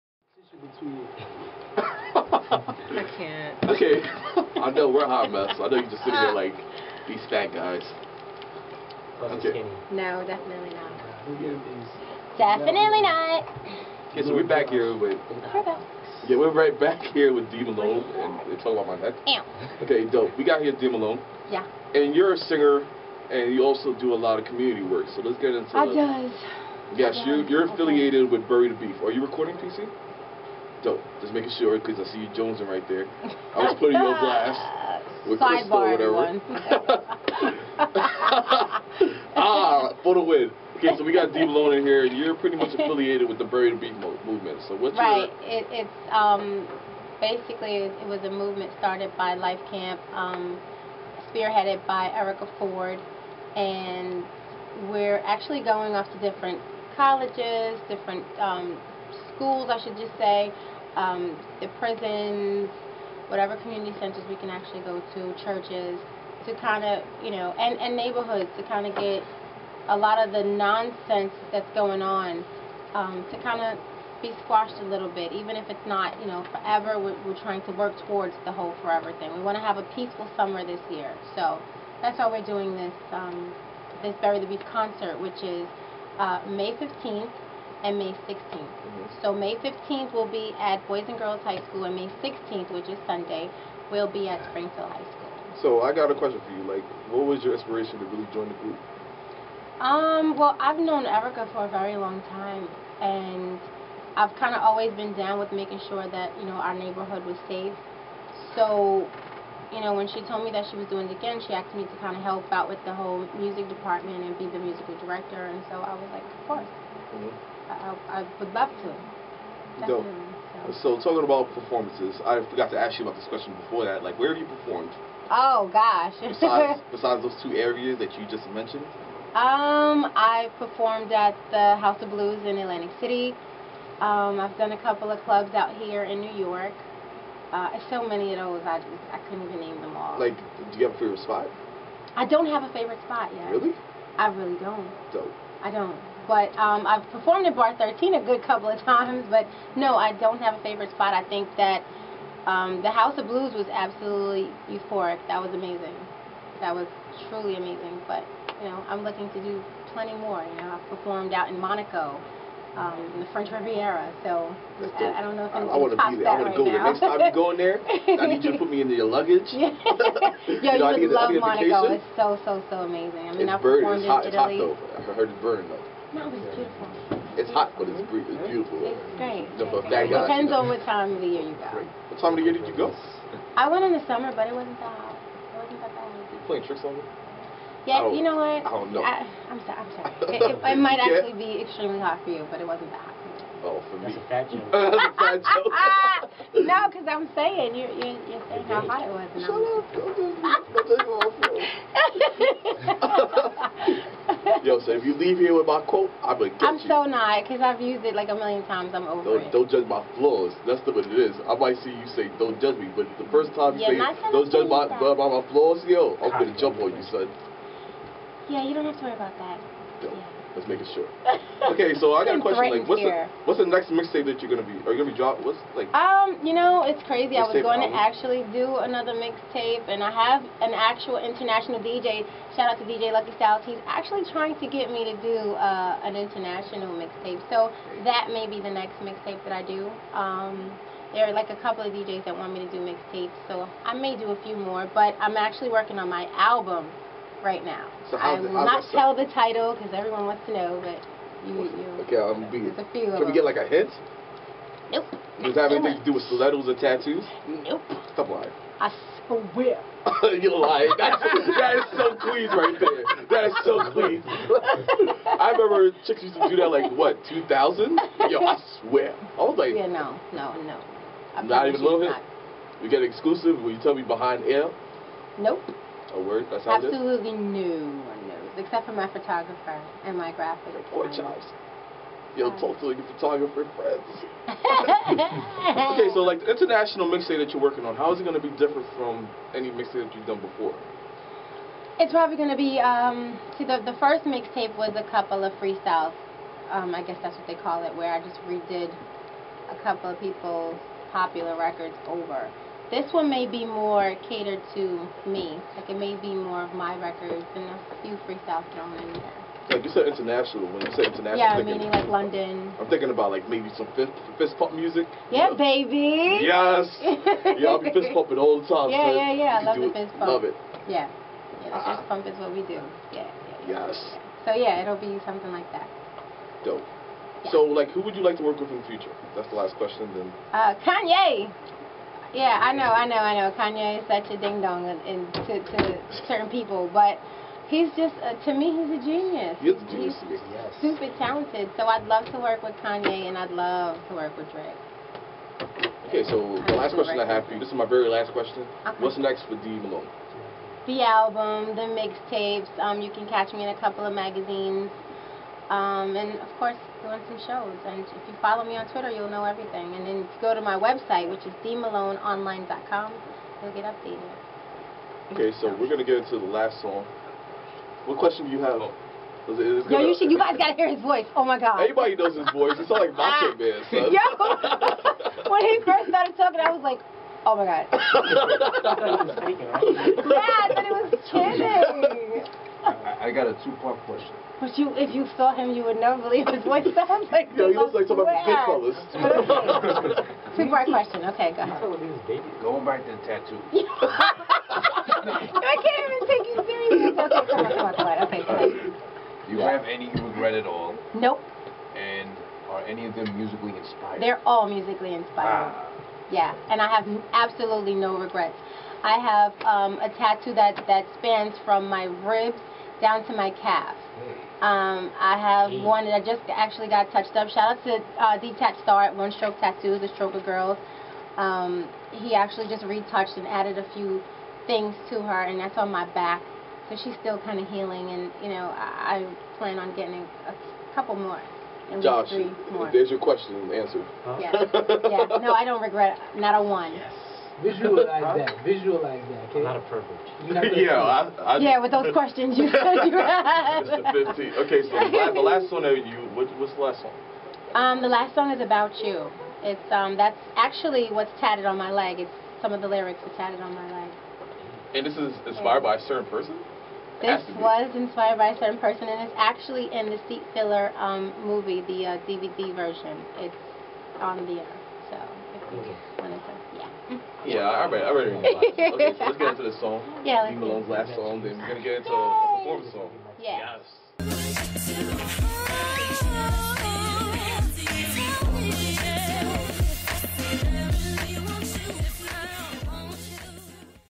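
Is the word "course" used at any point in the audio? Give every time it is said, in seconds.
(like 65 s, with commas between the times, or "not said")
116 s, 356 s.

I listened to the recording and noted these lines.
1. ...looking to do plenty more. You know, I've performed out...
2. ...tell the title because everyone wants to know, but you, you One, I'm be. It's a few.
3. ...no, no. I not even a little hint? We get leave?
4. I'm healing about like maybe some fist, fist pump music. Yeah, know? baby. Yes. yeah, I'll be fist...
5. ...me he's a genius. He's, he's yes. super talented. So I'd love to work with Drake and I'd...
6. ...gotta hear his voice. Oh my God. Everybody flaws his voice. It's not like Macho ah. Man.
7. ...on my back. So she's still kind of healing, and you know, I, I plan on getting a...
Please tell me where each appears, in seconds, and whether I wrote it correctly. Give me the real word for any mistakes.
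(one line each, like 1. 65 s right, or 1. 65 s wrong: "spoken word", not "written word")
1. 159 s right
2. 248 s wrong: "Okay", not "One"
3. 270 s wrong: "exclusive", not "leave"
4. 312 s wrong: "thinking", not "healing"
5. 338 s wrong: "Kanye", not "Drake"
6. 370 s wrong: "knows", not "flaws"
7. 425 s right.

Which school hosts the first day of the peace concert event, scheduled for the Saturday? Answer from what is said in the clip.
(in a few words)
Boys and Girls High School.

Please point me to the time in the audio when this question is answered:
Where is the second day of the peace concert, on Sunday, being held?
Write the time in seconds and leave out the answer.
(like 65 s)
94 s.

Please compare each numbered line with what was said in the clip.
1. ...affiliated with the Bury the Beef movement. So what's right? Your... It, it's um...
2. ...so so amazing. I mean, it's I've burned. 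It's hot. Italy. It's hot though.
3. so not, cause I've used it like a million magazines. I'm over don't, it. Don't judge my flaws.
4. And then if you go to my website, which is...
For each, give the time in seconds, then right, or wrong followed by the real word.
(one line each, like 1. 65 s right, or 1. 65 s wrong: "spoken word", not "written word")
1. 42 s right
2. 172 s right
3. 206 s wrong: "times", not "magazines"
4. 359 s right.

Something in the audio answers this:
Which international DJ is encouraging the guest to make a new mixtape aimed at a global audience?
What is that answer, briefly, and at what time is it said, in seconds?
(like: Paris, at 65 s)
DJ Lucky Styles, at 232 s.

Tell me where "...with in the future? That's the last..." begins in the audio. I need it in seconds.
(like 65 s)
328 s.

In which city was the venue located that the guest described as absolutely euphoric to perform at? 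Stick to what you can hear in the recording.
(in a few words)
Atlantic City.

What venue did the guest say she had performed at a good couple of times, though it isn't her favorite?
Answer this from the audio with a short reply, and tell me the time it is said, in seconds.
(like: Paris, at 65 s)
Bar 13, at 147 s.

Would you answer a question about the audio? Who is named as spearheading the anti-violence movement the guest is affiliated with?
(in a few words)
Erica Ford.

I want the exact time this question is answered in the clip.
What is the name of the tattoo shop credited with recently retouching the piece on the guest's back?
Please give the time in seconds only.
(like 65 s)
419 s.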